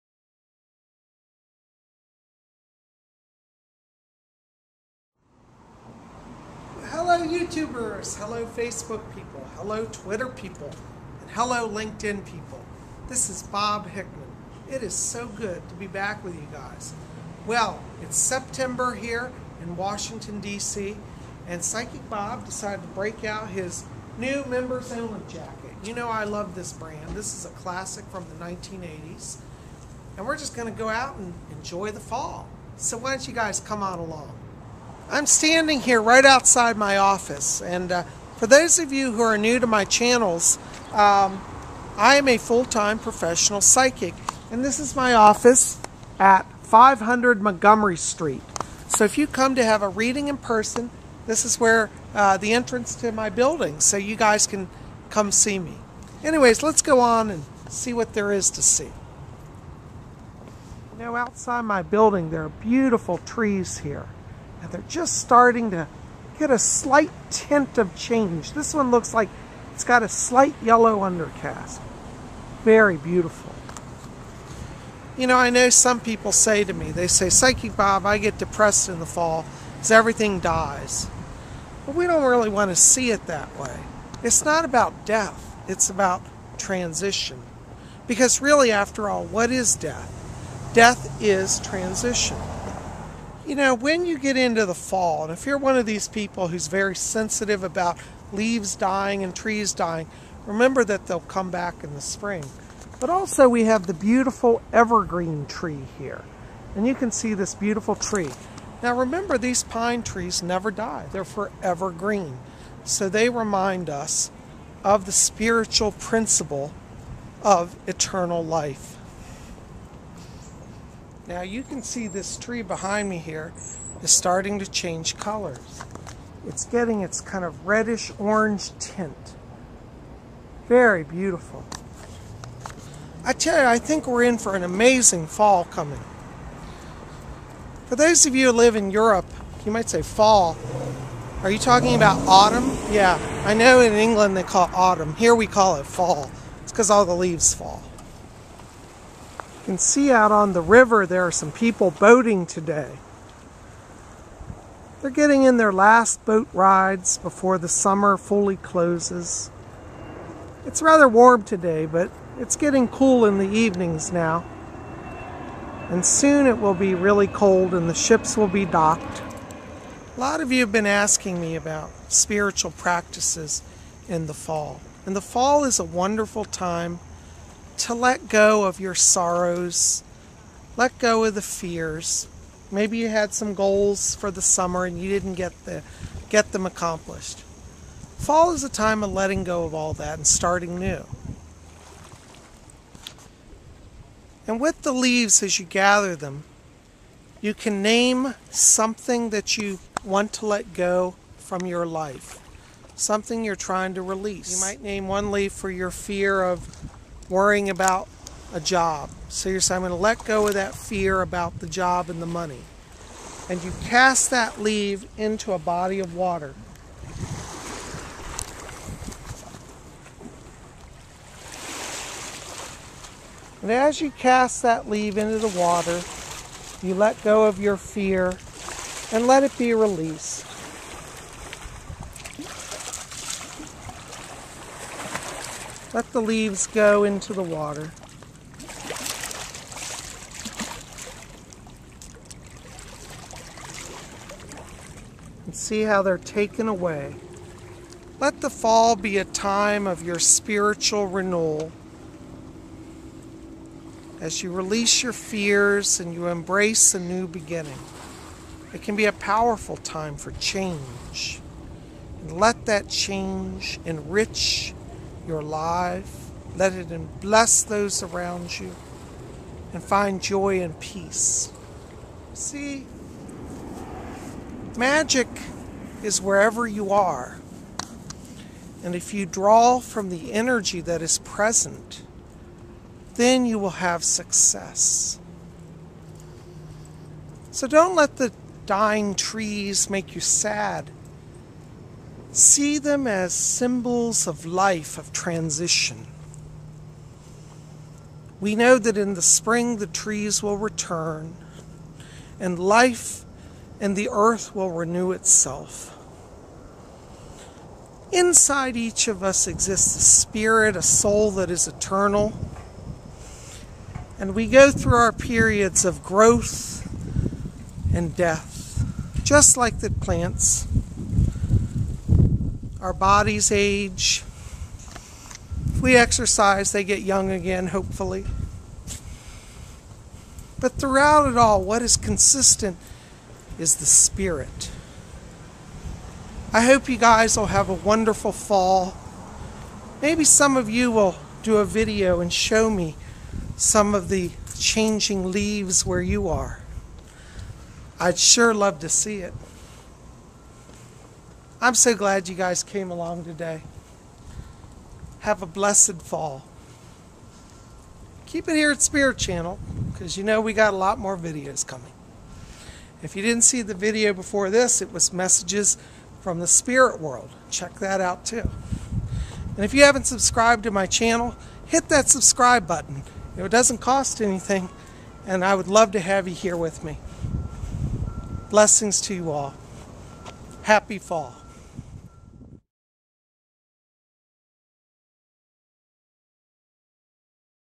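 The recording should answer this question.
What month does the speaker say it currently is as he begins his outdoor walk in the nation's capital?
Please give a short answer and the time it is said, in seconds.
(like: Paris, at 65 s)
September, at 18 s.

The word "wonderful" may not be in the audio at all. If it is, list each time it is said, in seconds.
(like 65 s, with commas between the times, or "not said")
175 s, 337 s.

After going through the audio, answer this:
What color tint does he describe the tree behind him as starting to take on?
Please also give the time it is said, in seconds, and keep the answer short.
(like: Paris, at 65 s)
Reddish orange, at 127 s.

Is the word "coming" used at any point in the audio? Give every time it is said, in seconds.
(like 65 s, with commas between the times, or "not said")
135 s, 361 s.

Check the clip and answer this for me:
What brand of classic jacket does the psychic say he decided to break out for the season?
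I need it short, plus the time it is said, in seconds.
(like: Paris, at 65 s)
Members Only, at 24 s.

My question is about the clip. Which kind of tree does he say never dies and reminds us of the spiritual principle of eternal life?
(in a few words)
Pine trees.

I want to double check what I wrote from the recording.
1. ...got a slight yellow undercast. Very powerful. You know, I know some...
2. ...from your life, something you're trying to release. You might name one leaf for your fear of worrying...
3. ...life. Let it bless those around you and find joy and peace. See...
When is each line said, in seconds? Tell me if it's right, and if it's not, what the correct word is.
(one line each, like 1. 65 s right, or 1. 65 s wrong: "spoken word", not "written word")
1. 69 s wrong: "beautiful", not "powerful"
2. 201 s right
3. 265 s right.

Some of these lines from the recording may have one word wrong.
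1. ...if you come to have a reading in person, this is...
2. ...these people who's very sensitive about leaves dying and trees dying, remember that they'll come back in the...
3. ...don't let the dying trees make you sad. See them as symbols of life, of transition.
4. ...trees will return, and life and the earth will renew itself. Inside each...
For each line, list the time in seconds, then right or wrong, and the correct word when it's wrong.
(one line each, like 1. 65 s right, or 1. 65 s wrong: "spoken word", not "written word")
1. 49 s right
2. 95 s right
3. 287 s right
4. 299 s right.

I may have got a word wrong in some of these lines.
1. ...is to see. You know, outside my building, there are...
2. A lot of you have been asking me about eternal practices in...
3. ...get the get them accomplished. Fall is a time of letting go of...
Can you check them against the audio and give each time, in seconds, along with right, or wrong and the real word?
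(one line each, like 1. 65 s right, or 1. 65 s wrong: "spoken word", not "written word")
1. 58 s right
2. 170 s wrong: "spiritual", not "eternal"
3. 185 s right.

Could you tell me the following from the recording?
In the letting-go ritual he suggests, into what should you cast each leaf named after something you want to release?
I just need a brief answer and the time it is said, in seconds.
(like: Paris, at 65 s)
A body of water, at 215 s.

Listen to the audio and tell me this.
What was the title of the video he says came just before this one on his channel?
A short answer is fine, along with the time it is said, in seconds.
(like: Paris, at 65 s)
Messages from the spirit world, at 365 s.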